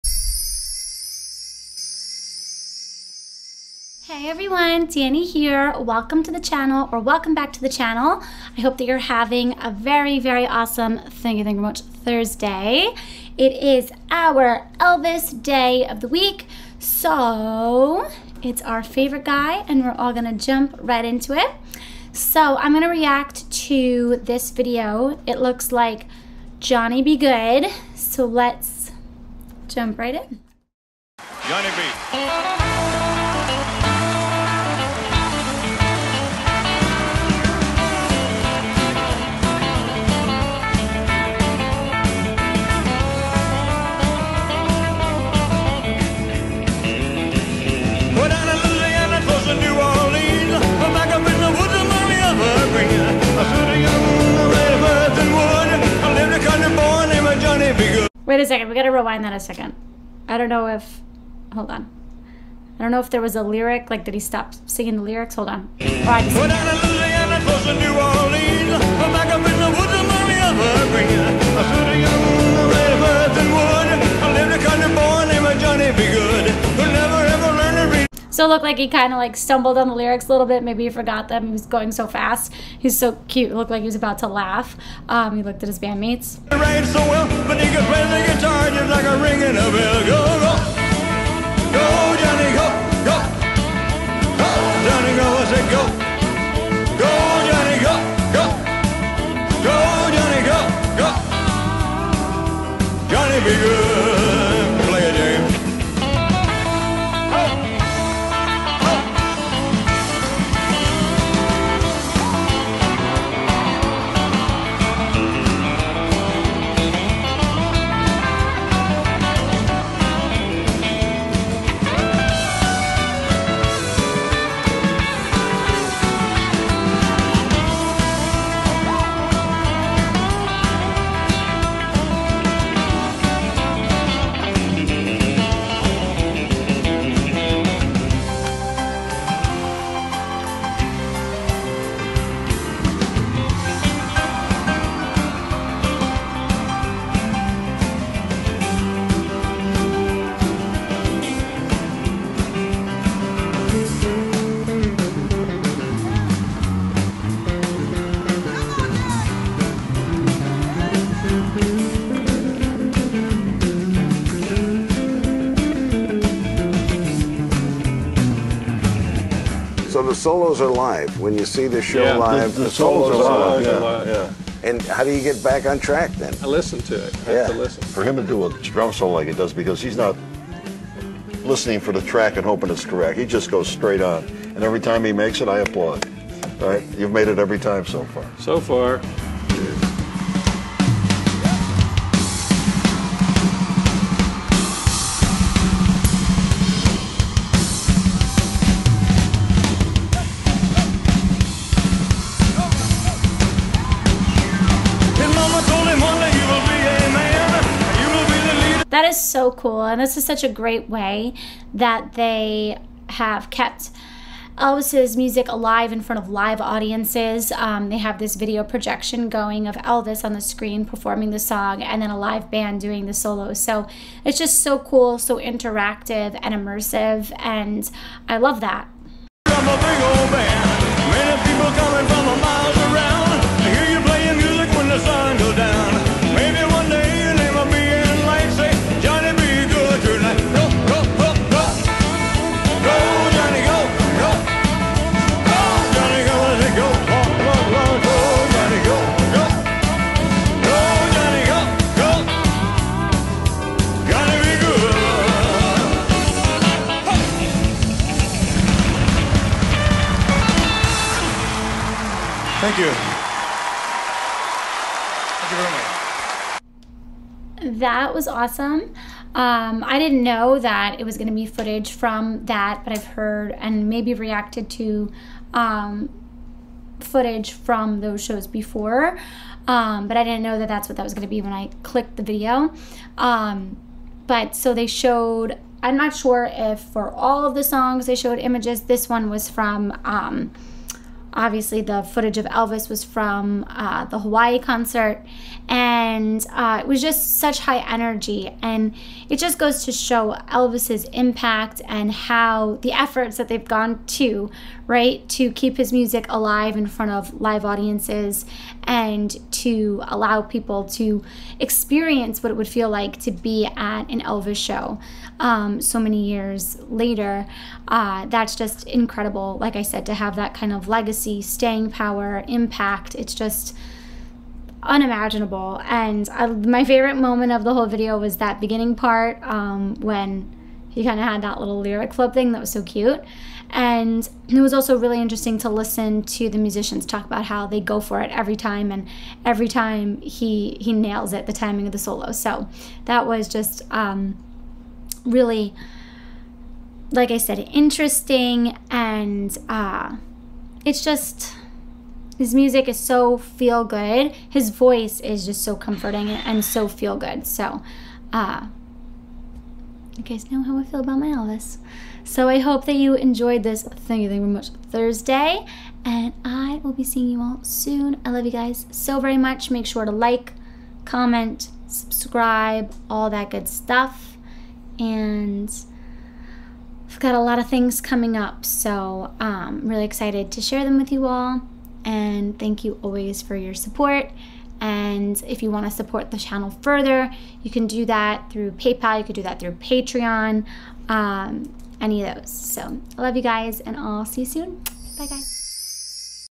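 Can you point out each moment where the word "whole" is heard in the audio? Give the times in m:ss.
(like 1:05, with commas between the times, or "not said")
5:27.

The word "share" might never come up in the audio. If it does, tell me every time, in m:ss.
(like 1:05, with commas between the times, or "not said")
6:20.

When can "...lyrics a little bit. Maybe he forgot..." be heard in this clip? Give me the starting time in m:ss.
1:19.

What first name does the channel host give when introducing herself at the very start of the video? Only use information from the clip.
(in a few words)
Dani.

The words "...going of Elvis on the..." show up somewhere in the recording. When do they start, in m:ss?
3:39.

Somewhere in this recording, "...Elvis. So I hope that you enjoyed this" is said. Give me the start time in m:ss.
6:01.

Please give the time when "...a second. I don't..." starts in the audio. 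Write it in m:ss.
0:59.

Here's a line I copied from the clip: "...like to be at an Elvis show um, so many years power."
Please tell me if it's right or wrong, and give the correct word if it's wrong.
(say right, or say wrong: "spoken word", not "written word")
wrong: "later", not "power".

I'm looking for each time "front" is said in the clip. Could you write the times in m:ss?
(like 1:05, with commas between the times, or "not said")
3:36, 5:06.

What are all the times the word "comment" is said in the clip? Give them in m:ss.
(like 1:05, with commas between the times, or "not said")
6:11.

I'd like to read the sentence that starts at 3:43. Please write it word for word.
So it's just so cool, so interactive and immersive.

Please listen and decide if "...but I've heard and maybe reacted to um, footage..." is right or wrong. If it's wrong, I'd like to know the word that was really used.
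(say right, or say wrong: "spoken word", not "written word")
right.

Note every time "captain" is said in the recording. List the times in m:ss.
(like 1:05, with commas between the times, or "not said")
not said.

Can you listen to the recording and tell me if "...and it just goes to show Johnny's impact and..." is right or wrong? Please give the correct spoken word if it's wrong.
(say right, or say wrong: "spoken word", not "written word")
wrong: "Elvis", not "Johnny".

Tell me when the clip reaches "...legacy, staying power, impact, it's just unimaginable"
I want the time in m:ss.
5:20.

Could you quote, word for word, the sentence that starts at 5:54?
His voice is just so comforting and, and so feel good.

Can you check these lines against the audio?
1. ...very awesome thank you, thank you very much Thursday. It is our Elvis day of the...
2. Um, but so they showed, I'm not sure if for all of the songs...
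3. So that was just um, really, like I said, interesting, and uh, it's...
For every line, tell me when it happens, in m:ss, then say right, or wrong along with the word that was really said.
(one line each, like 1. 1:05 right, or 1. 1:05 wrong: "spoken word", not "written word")
1. 0:10 right
2. 4:43 right
3. 5:42 right.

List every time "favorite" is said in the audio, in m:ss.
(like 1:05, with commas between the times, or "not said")
0:18, 5:26.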